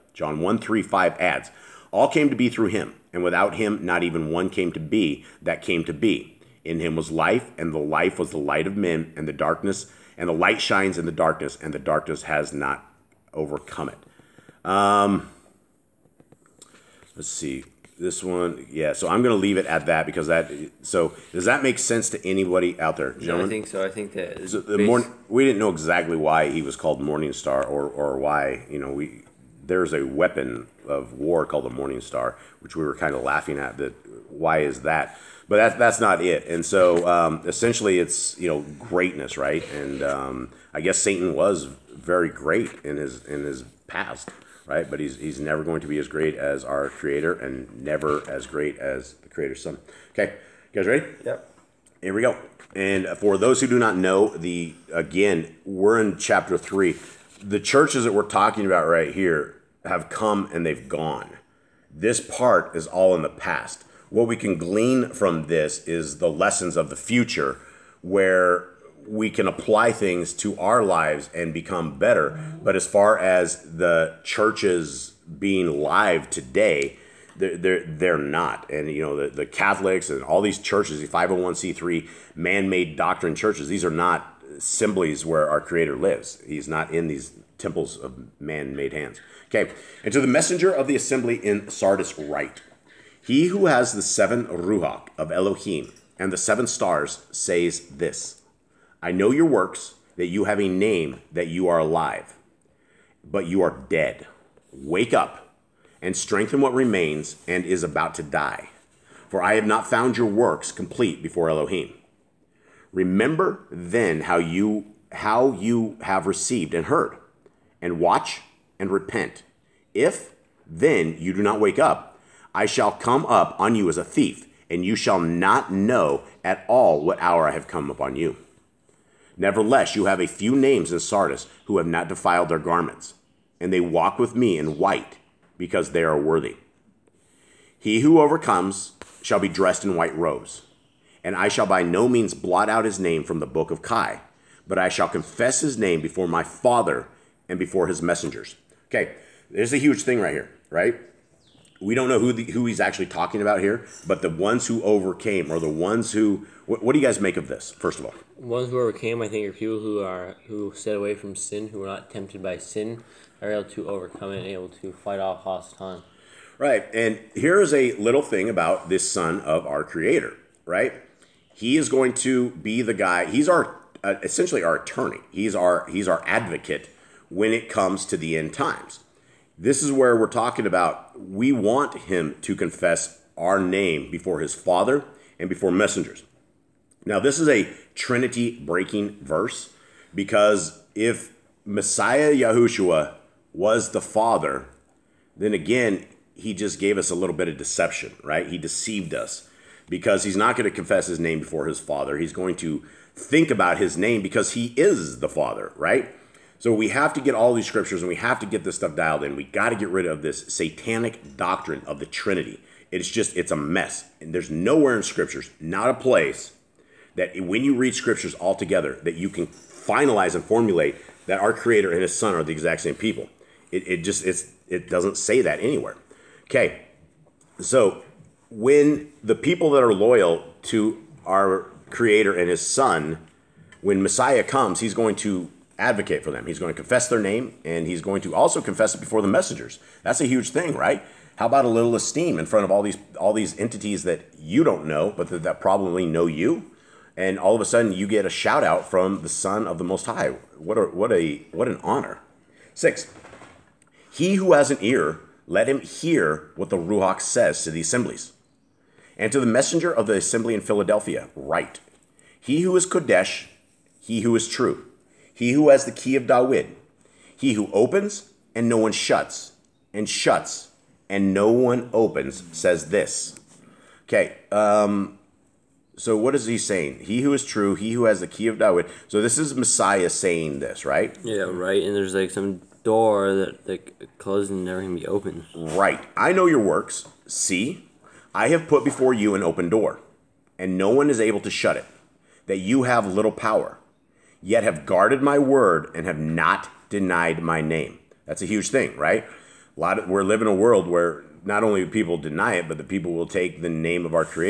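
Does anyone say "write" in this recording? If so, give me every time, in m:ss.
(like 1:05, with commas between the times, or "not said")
1:32, 4:21.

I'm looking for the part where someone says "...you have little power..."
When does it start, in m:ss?
4:52.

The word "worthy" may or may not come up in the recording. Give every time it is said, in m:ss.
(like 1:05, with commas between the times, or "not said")
2:16.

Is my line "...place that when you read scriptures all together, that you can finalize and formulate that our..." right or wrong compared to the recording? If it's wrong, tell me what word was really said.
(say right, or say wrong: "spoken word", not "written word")
right.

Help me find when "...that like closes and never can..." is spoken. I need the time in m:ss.
4:43.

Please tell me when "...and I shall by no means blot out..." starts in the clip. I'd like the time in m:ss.
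2:21.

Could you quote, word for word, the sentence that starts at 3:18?
He deceived us because he's not going to confess his name before his Father.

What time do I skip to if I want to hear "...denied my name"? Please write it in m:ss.
4:56.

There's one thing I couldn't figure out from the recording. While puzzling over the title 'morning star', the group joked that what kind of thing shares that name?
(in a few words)
A weapon of war.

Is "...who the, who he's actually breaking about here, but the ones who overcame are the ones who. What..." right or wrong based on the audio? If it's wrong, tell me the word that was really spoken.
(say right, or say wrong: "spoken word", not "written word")
wrong: "talking", not "breaking".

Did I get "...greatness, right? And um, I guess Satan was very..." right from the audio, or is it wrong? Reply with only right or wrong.
right.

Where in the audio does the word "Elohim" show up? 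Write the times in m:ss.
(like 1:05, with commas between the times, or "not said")
1:35, 1:51.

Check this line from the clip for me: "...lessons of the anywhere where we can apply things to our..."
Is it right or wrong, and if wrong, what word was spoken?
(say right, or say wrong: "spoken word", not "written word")
wrong: "future", not "anywhere".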